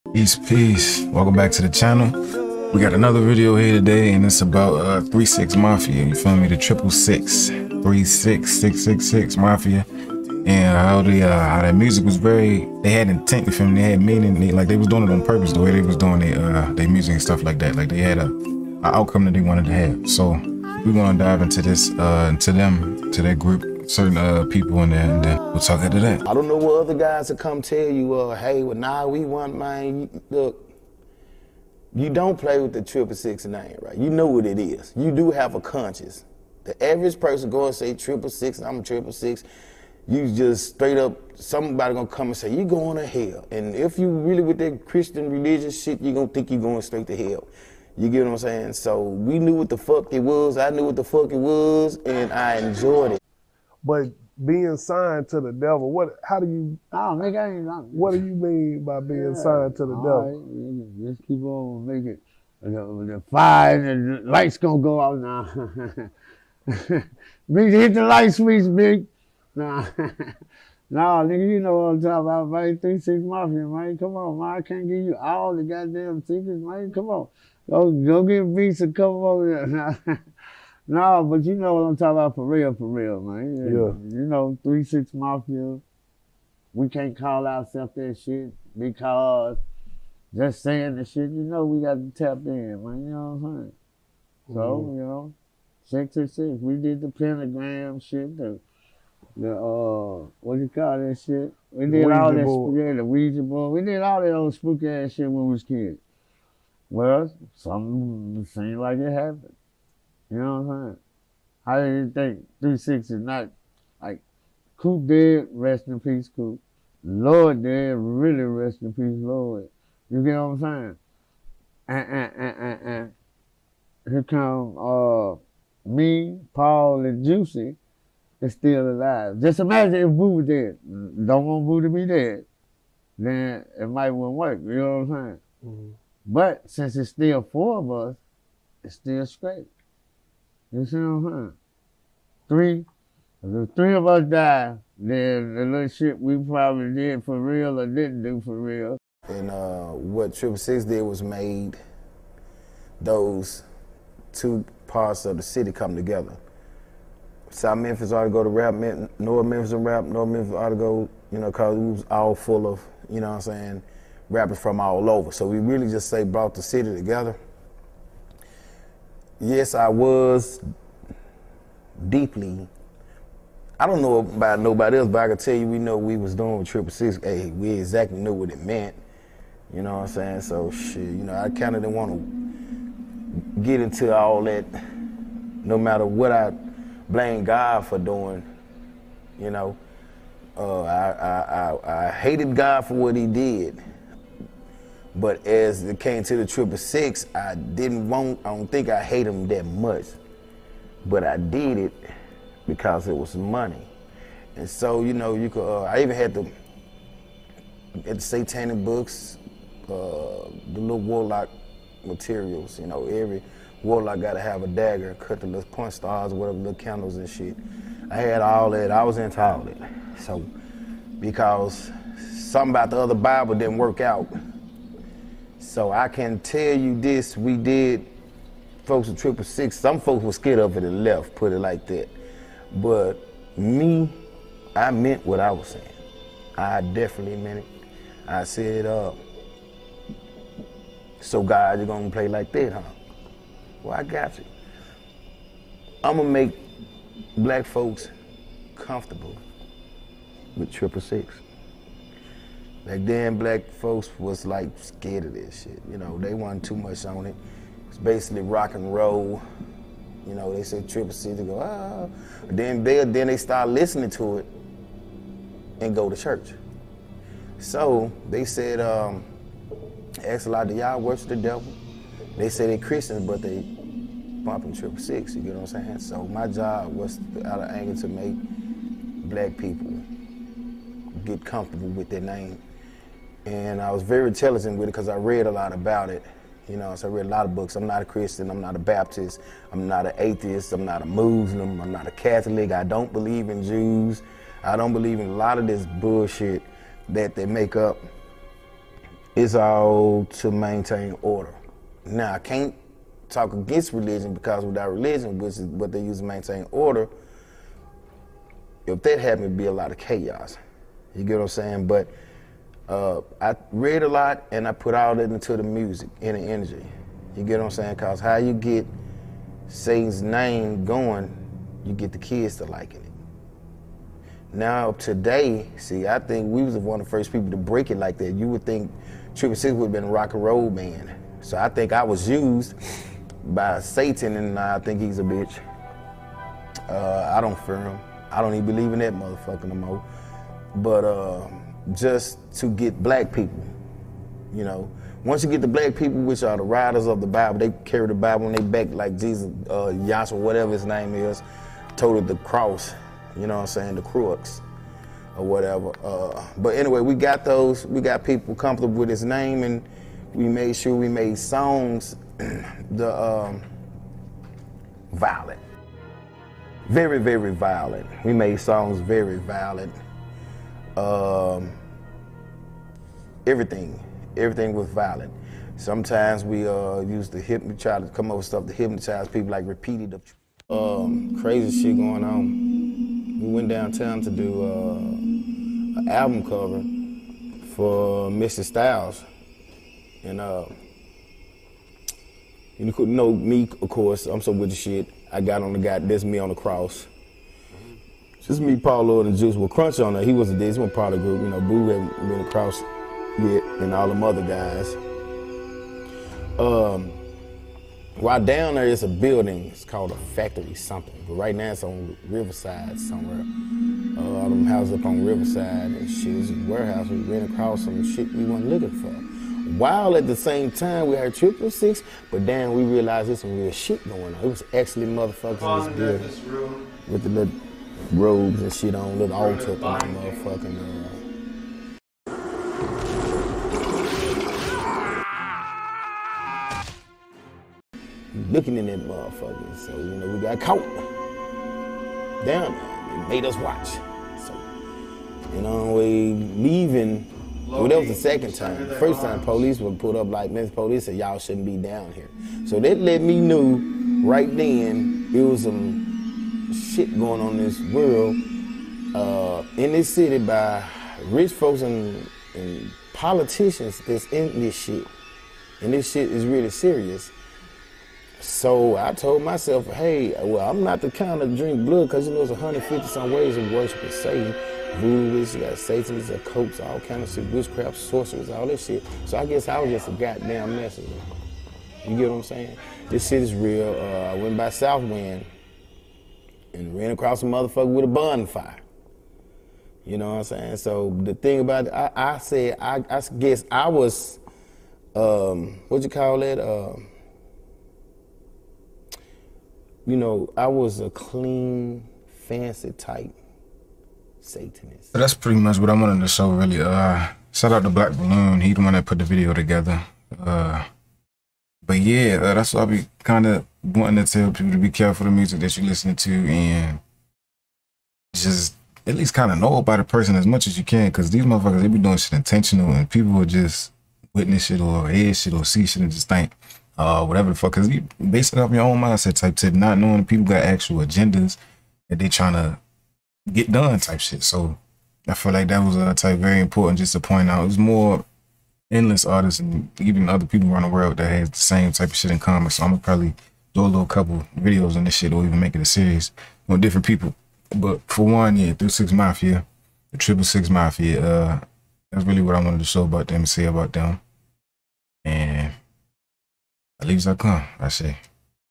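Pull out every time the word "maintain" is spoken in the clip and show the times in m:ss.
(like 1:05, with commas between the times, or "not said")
5:00, 5:06.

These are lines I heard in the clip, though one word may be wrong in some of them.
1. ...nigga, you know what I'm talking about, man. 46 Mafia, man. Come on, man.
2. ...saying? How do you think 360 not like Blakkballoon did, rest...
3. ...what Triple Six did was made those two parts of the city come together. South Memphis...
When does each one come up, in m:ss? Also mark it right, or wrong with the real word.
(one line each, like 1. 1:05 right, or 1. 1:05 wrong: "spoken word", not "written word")
1. 1:11 wrong: "36", not "46"
2. 1:50 wrong: "Coop", not "Blakkballoon"
3. 2:29 right.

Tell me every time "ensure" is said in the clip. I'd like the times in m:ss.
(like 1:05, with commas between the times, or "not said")
not said.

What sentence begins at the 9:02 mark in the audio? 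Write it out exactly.
So I'm gonna probably do a little couple videos on this shit or even make it a series on different people.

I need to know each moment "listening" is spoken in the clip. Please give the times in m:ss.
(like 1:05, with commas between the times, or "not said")
4:23, 8:35.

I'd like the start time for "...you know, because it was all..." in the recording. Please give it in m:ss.
2:41.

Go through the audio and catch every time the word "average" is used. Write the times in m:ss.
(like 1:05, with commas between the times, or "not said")
0:36.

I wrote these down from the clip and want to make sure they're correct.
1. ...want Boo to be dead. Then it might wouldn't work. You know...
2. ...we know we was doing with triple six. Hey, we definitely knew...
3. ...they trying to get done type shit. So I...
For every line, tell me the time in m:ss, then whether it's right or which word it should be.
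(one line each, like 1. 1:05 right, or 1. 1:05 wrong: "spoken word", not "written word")
1. 2:11 right
2. 2:55 wrong: "exactly", not "definitely"
3. 8:52 right.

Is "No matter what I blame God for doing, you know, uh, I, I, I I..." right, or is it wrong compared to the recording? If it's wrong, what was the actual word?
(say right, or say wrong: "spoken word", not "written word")
right.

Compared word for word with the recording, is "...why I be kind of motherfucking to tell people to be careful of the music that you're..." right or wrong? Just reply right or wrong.
wrong.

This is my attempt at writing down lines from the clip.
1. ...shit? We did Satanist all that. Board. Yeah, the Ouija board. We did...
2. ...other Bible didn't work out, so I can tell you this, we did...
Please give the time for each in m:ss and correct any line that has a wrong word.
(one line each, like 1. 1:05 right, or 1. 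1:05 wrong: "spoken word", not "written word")
1. 1:41 wrong: "Ouija", not "Satanist"
2. 3:42 right.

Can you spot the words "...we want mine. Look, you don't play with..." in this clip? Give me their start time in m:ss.
0:29.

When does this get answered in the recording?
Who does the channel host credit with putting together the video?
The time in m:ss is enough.
8:27.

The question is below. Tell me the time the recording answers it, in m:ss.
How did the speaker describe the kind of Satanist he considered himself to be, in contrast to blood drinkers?
8:21.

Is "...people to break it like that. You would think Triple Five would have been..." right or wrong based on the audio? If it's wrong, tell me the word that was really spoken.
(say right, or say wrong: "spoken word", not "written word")
wrong: "Six", not "Five".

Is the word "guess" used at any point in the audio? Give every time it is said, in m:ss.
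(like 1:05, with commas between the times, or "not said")
7:59, 8:13.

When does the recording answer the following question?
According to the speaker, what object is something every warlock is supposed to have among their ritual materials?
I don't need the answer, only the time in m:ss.
3:34.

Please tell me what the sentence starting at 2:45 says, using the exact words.
So we really just, say, brought the city together yes, I was deeply.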